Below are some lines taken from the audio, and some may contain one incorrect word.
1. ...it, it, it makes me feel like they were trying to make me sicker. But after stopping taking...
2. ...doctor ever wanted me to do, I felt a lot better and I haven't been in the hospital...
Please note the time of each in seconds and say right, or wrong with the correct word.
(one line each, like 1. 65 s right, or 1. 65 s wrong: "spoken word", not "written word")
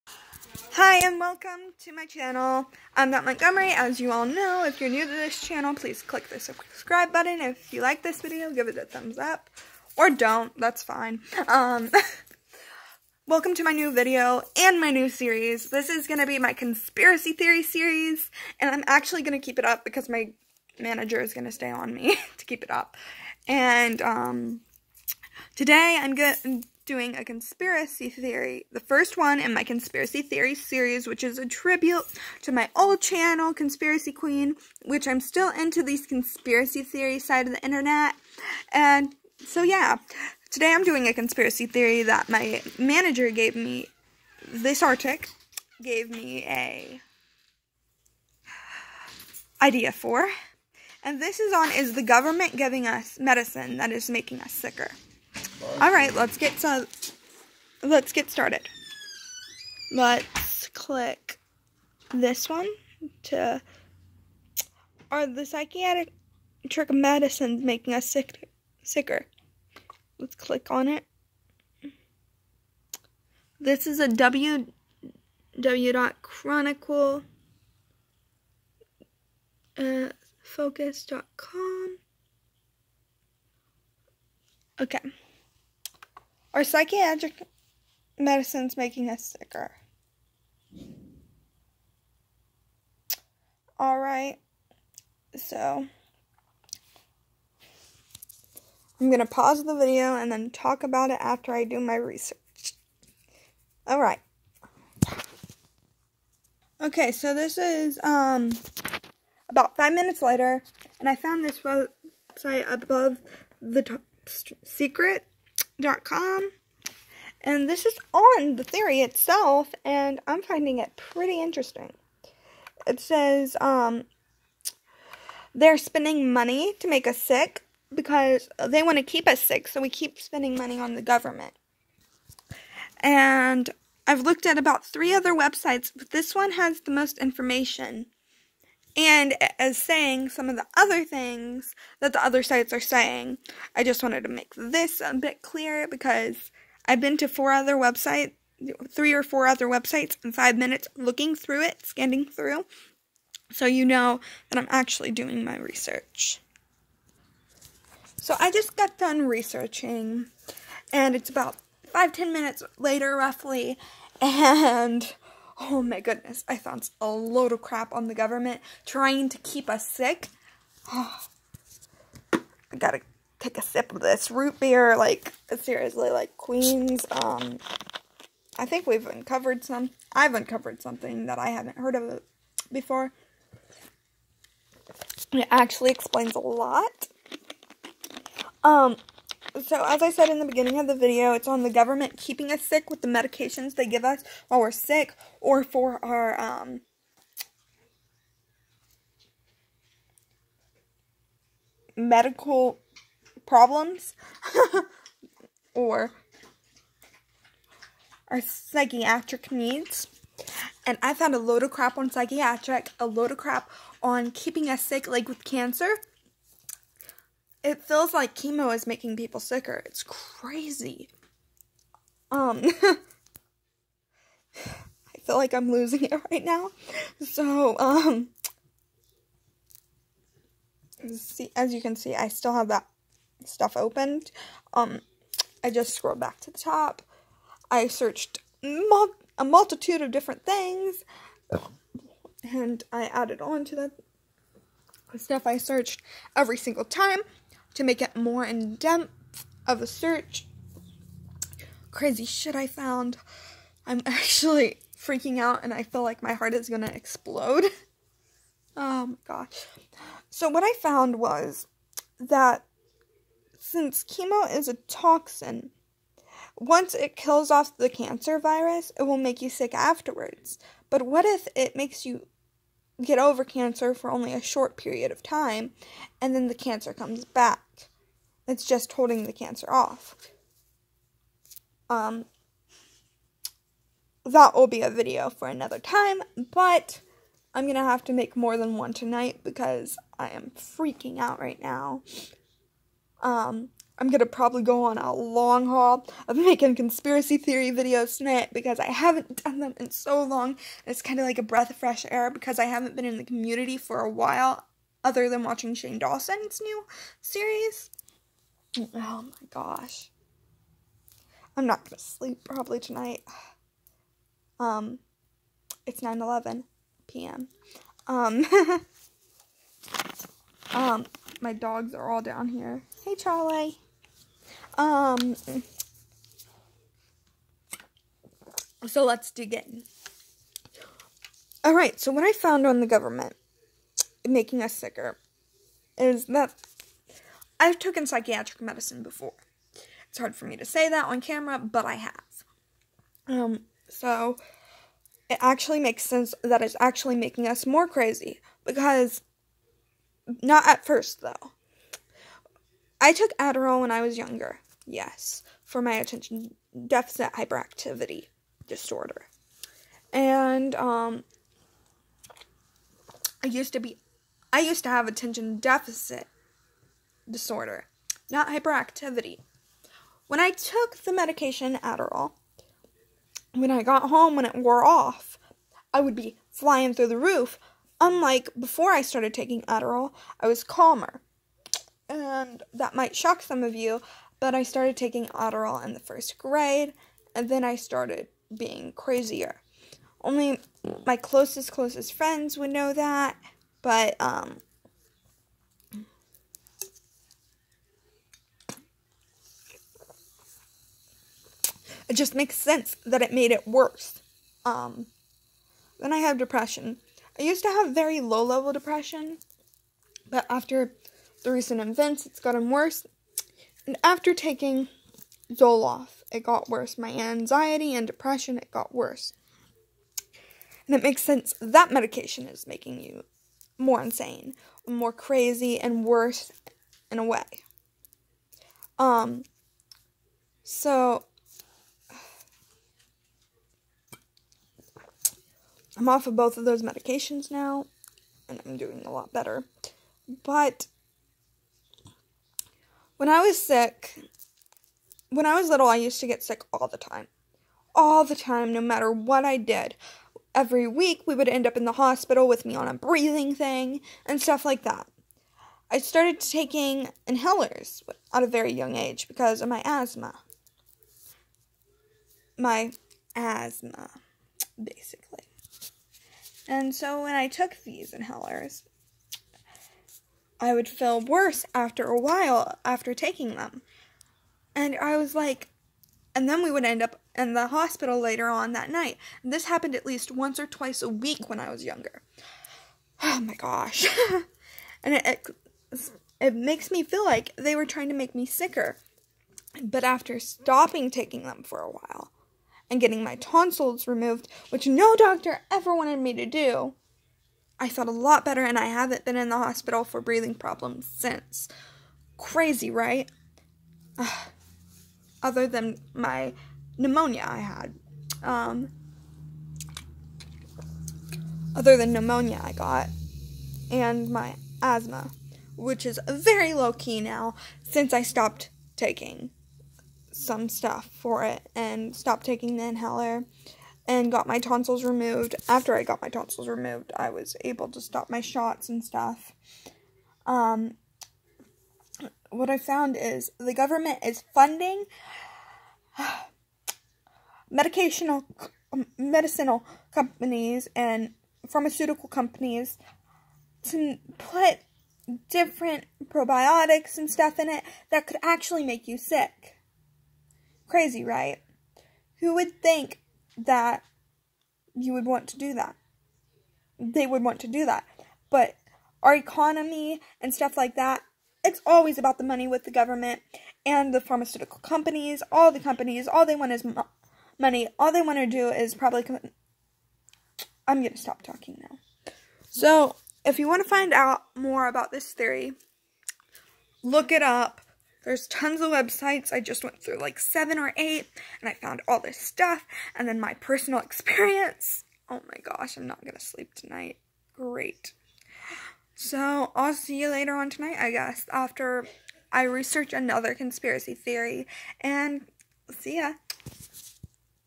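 1. 485 s right
2. 495 s right.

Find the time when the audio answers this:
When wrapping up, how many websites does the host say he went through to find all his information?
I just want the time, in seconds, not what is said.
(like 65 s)
580 s.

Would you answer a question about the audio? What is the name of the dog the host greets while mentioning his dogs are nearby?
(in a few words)
Charlie.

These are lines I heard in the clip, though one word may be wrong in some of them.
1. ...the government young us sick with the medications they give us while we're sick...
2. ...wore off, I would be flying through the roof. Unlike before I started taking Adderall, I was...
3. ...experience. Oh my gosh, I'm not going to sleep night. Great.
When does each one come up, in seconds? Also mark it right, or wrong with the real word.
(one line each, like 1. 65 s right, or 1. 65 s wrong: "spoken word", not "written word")
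1. 191 s wrong: "keeping", not "young"
2. 374 s right
3. 583 s wrong: "tonight", not "night".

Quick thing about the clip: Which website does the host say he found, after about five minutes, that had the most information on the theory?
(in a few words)
Above the Top Secret.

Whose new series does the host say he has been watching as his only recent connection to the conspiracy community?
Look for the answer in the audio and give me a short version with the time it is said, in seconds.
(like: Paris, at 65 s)
Shane Dawson, at 305 s.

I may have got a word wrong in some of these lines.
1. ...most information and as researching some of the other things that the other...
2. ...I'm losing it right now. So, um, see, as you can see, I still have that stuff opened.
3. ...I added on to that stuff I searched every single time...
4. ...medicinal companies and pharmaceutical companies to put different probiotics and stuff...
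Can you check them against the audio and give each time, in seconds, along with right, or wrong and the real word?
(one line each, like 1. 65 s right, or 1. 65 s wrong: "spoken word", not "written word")
1. 136 s wrong: "saying", not "researching"
2. 225 s right
3. 242 s right
4. 539 s right.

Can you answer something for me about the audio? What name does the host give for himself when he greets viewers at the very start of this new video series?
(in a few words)
Matt Montgomery.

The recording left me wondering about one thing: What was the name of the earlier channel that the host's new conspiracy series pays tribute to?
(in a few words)
Conspiracy Queen.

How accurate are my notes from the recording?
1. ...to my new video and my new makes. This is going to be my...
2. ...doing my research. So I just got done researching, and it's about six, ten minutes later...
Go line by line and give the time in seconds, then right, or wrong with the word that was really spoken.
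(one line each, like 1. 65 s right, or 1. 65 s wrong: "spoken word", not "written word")
1. 13 s wrong: "series", not "makes"
2. 155 s wrong: "five", not "six".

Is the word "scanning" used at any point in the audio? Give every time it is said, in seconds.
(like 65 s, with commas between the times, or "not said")
151 s.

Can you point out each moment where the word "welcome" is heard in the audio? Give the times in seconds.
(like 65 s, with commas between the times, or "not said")
1 s, 13 s.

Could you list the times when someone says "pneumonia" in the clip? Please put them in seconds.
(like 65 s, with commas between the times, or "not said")
506 s, 512 s.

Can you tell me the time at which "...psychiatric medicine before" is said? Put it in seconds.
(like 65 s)
338 s.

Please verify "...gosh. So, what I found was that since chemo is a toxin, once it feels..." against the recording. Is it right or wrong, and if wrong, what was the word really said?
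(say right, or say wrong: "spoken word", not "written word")
wrong: "kills", not "feels".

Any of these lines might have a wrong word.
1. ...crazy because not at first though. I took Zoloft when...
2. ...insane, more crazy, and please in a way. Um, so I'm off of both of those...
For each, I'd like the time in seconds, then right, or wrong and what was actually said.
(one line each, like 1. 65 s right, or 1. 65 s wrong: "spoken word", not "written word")
1. 347 s wrong: "Adderall", not "Zoloft"
2. 424 s wrong: "worse", not "please".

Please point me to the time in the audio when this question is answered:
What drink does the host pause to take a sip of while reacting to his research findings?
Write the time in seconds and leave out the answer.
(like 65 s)
174 s.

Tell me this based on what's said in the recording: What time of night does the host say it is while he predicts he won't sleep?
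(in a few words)
9:11 p.m.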